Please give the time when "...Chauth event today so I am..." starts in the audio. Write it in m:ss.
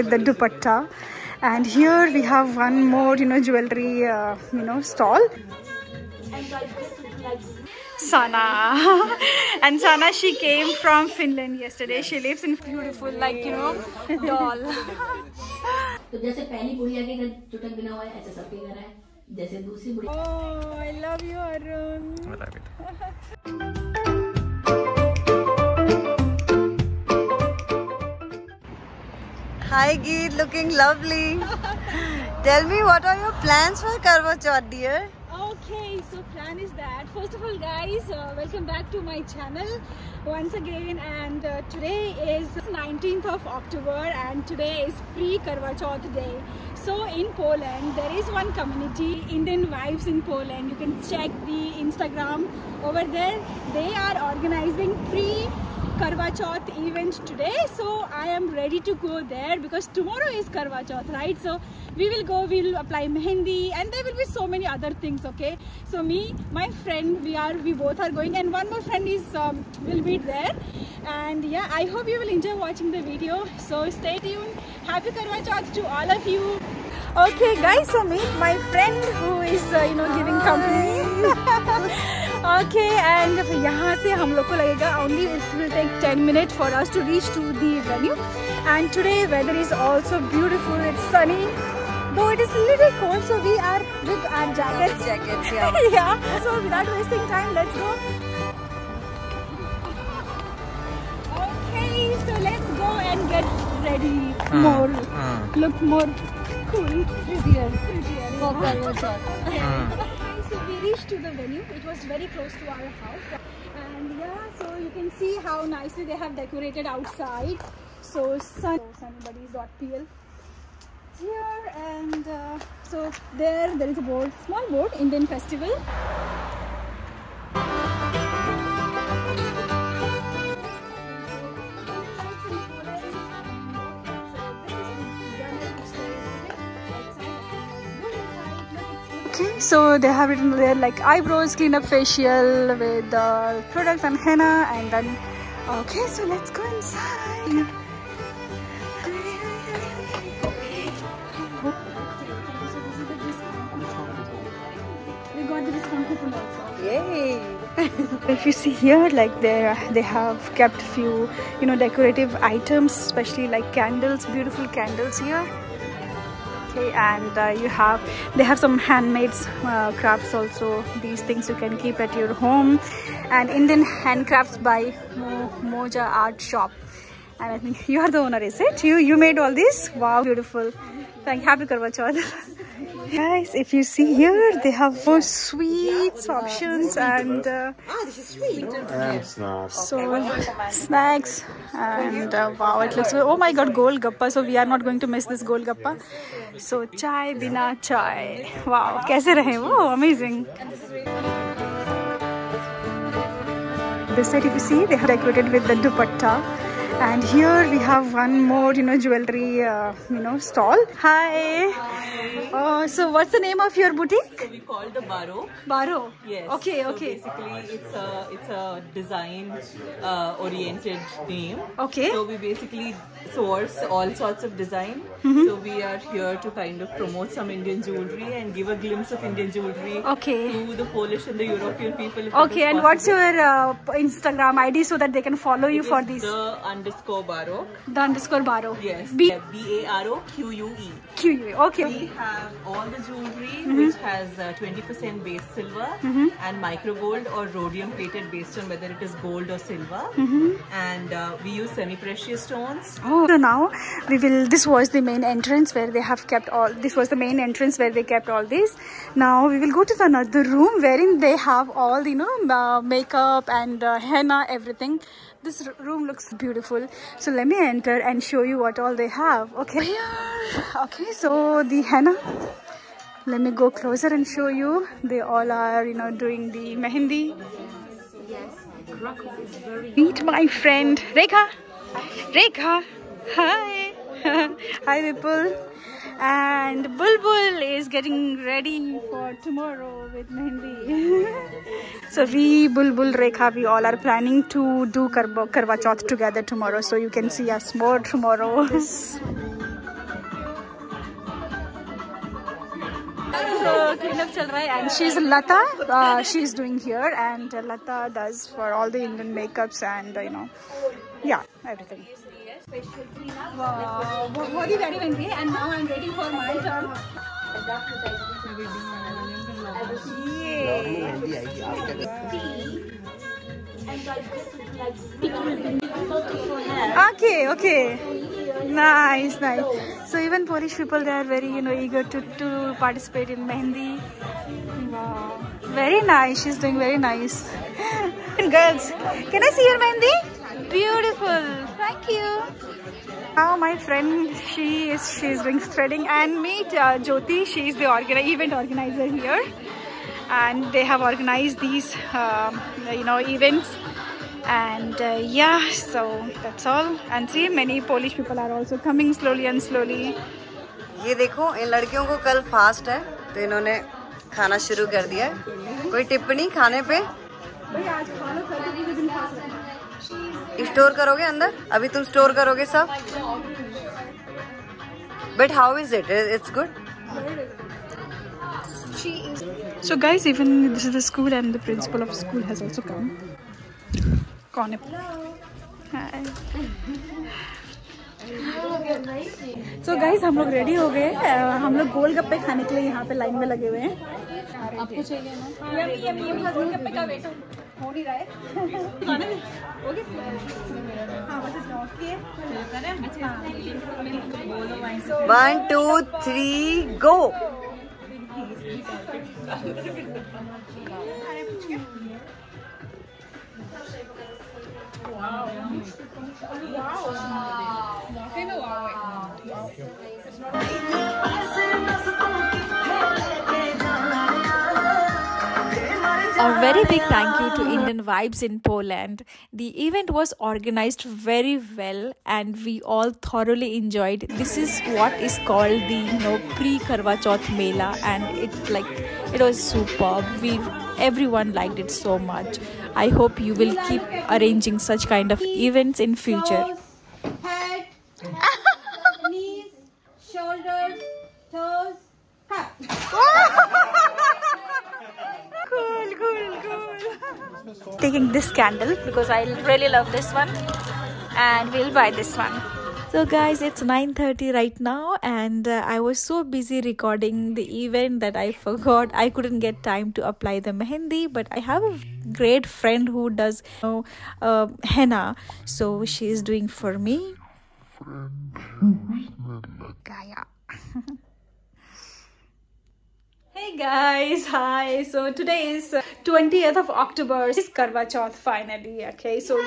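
0:56.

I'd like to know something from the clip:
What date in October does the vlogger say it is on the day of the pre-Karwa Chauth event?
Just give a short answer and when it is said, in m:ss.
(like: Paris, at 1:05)
19th of October, at 0:42.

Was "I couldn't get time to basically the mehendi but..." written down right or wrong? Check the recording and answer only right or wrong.
wrong.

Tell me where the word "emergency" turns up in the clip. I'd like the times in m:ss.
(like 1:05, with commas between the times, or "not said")
not said.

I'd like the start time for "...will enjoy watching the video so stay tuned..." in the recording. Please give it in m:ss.
1:12.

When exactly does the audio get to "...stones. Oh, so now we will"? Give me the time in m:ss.
4:12.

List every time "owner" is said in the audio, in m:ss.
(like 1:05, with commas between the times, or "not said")
2:58.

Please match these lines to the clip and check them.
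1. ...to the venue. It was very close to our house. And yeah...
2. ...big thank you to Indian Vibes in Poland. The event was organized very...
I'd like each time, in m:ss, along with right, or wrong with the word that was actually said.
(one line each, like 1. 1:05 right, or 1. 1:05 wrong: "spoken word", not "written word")
1. 1:51 right
2. 7:06 right.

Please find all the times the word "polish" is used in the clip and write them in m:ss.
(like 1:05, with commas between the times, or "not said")
3:50, 5:30, 5:57.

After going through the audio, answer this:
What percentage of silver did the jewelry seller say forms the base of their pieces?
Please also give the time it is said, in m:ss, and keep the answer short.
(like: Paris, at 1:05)
20%, at 4:04.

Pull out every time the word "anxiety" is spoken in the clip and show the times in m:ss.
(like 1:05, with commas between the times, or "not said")
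not said.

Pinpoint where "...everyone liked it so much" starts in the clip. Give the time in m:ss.
7:20.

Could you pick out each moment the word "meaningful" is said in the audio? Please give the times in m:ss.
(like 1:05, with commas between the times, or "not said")
not said.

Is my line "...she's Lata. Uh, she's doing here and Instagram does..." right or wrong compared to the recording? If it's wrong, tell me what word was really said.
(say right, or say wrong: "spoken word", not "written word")
wrong: "Lata", not "Instagram".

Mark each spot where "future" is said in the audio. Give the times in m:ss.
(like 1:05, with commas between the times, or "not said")
7:26.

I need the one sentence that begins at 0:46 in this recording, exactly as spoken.
So in Poland, there is one community, Indian wives in Poland.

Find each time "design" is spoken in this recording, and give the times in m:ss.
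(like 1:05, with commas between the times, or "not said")
3:38, 3:44.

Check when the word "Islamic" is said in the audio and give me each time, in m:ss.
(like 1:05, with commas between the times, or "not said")
not said.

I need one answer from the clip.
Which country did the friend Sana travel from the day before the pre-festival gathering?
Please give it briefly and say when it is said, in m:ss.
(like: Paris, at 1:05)
Finland, at 0:11.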